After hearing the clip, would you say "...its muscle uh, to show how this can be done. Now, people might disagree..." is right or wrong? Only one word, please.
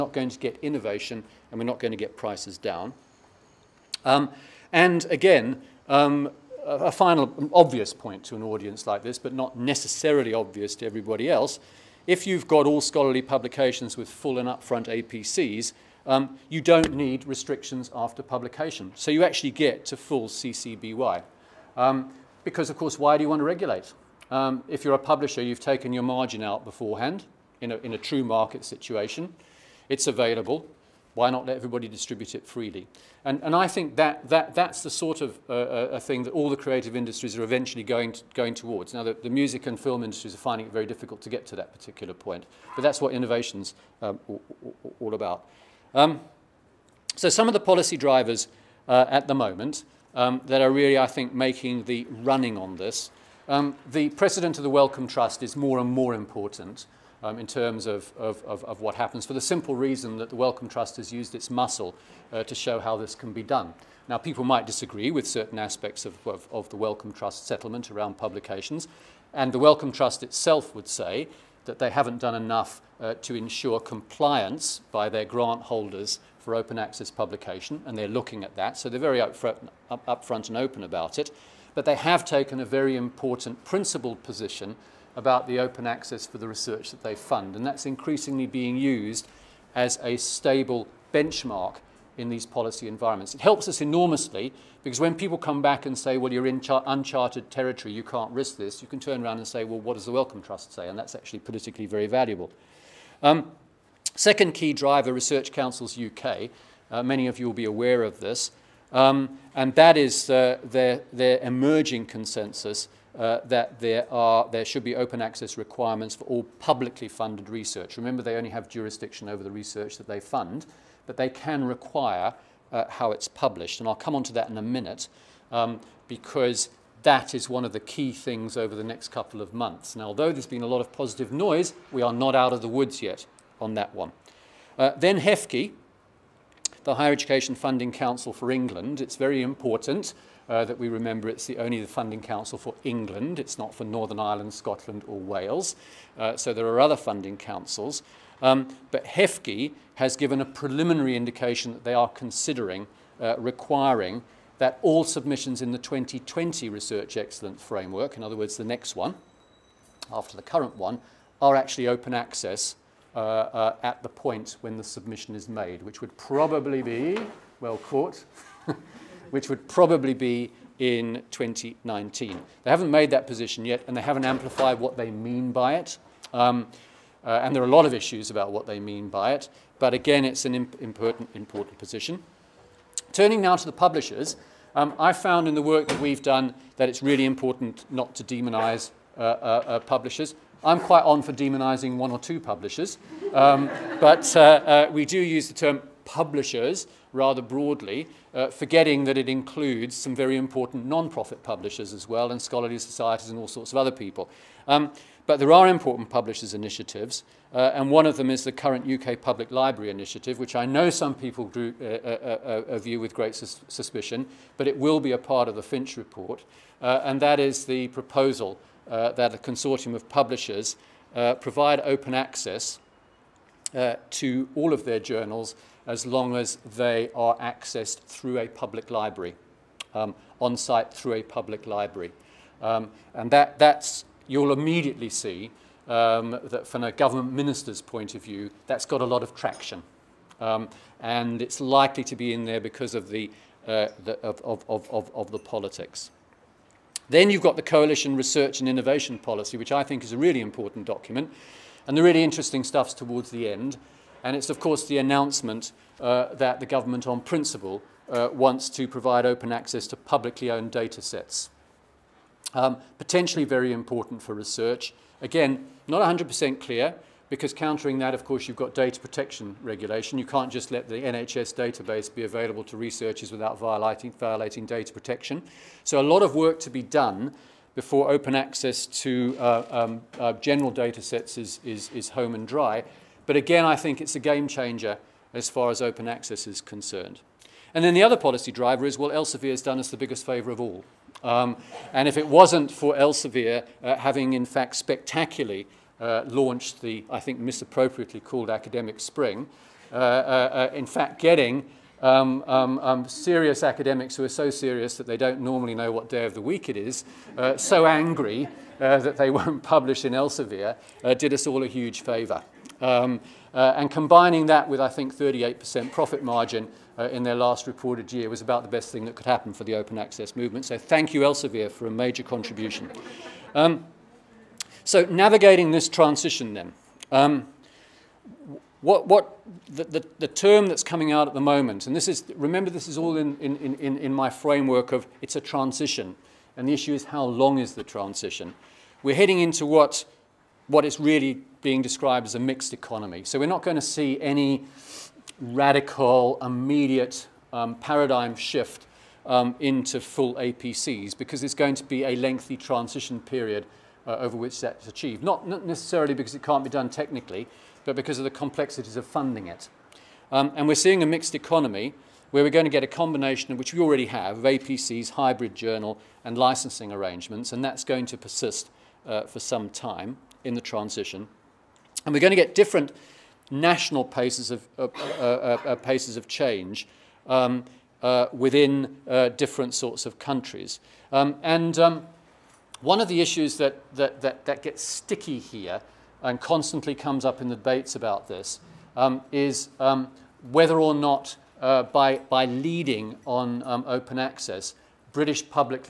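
right.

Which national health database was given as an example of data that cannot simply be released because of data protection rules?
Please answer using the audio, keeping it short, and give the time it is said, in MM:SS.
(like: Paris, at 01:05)
NHS, at 04:30.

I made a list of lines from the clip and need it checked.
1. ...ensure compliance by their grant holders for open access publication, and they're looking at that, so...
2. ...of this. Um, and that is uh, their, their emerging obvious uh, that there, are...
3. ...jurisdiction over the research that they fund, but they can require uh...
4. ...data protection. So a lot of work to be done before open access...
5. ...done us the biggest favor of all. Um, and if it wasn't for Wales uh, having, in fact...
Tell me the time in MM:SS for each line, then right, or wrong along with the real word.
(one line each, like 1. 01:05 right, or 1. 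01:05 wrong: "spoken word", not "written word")
1. 01:13 right
2. 01:48 wrong: "consensus", not "obvious"
3. 01:58 right
4. 04:34 right
5. 04:49 wrong: "Elsevier", not "Wales".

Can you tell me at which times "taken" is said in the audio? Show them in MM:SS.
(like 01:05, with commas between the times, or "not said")
00:25, 01:22.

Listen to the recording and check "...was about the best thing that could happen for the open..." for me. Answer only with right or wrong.
right.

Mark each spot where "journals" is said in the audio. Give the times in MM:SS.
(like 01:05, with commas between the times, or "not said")
03:44, 06:05.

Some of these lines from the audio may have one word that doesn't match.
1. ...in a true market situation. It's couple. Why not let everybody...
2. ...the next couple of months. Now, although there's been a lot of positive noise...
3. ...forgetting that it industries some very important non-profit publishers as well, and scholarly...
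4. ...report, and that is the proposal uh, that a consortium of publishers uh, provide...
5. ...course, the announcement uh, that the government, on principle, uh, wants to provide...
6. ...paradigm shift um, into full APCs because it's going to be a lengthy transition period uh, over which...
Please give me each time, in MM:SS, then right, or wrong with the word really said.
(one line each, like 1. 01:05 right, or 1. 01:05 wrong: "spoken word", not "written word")
1. 00:27 wrong: "available", not "couple"
2. 02:08 right
3. 03:18 wrong: "includes", not "industries"
4. 03:35 right
5. 04:14 right
6. 05:47 right.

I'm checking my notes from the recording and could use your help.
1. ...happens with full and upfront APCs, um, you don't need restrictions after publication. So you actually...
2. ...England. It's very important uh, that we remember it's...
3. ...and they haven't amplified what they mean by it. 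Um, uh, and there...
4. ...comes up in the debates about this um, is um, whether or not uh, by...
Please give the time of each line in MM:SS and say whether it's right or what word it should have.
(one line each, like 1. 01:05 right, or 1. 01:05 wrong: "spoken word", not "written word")
1. 00:13 wrong: "publications", not "happens"
2. 02:18 right
3. 02:53 right
4. 06:26 right.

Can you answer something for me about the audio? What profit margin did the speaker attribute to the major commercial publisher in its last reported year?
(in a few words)
38%.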